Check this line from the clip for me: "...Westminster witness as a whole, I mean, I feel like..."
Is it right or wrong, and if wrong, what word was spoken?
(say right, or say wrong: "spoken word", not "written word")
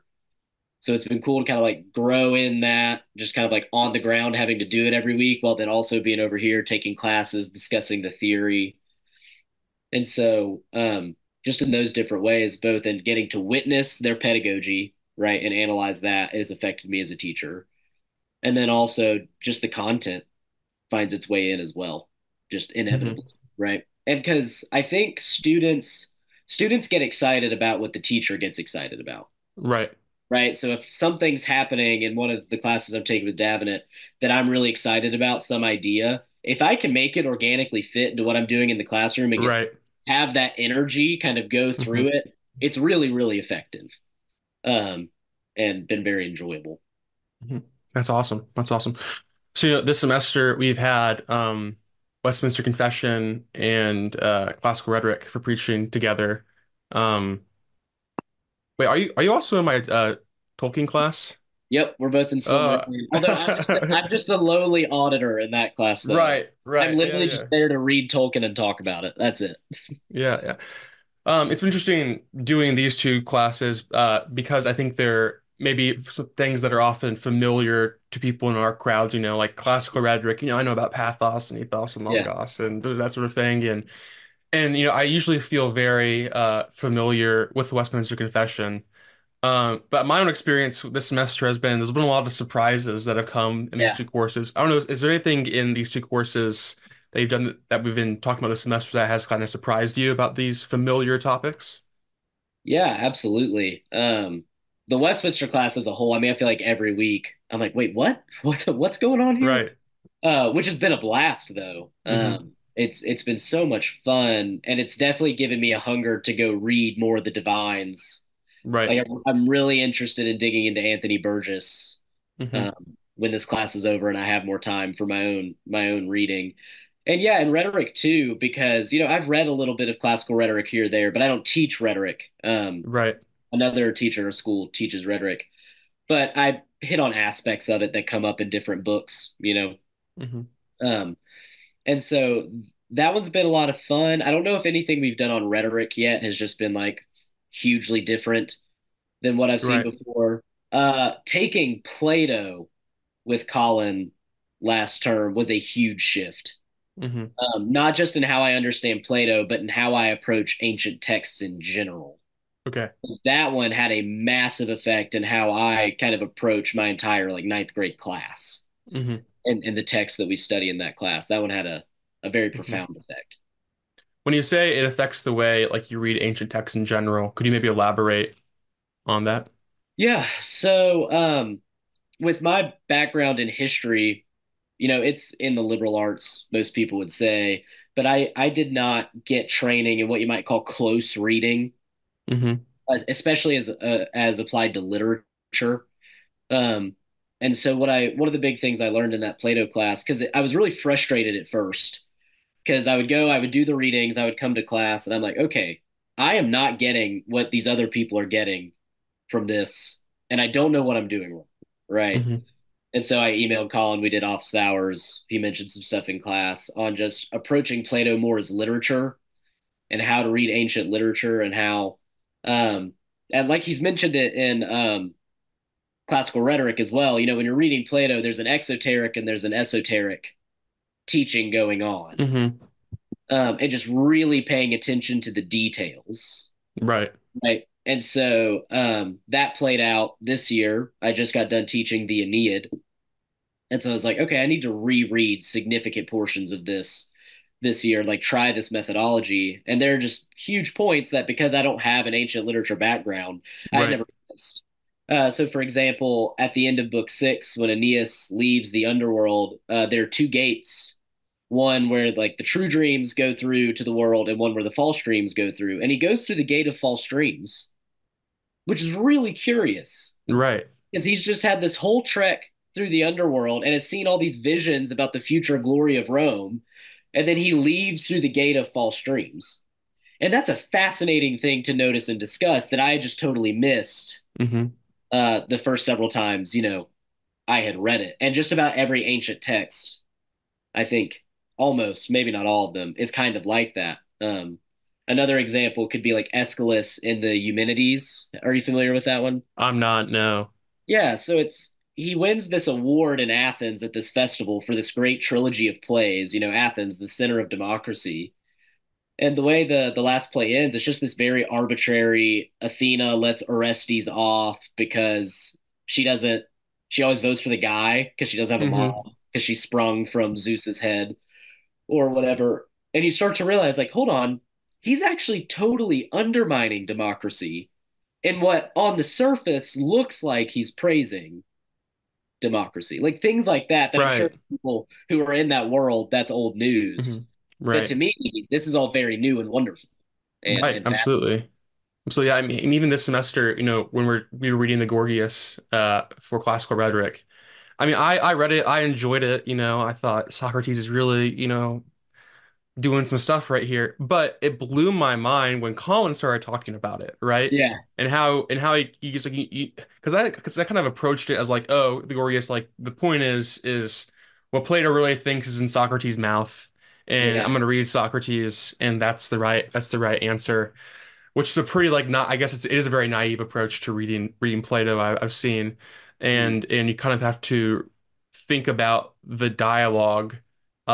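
wrong: "class", not "witness".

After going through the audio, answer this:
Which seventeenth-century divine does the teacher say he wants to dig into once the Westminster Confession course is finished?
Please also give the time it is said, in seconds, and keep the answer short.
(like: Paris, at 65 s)
Anthony Burgess, at 120 s.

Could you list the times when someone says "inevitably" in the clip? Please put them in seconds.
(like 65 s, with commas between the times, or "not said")
22 s.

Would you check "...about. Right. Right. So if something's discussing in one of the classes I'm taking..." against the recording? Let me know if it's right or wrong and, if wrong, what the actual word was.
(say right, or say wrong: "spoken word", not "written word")
wrong: "happening", not "discussing".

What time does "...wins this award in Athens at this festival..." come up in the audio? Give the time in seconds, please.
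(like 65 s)
302 s.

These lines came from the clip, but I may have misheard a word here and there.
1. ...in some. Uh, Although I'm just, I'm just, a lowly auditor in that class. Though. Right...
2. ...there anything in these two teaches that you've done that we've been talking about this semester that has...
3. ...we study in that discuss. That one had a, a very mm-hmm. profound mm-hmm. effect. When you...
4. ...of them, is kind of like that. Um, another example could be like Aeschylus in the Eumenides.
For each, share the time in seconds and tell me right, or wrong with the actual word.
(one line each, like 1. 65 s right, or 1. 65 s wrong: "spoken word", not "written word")
1. 62 s right
2. 94 s wrong: "courses", not "teaches"
3. 170 s wrong: "class", not "discuss"
4. 292 s right.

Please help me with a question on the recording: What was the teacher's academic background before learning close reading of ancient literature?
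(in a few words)
History.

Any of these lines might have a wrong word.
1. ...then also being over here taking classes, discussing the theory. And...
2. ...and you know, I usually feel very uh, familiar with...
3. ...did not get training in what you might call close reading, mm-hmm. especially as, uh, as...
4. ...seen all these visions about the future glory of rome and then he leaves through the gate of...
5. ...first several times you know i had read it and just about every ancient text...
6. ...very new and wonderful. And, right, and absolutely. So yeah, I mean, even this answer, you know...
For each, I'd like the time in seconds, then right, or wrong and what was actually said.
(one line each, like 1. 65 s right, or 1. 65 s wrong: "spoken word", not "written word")
1. 5 s right
2. 84 s right
3. 188 s right
4. 273 s right
5. 285 s right
6. 338 s wrong: "semester", not "answer".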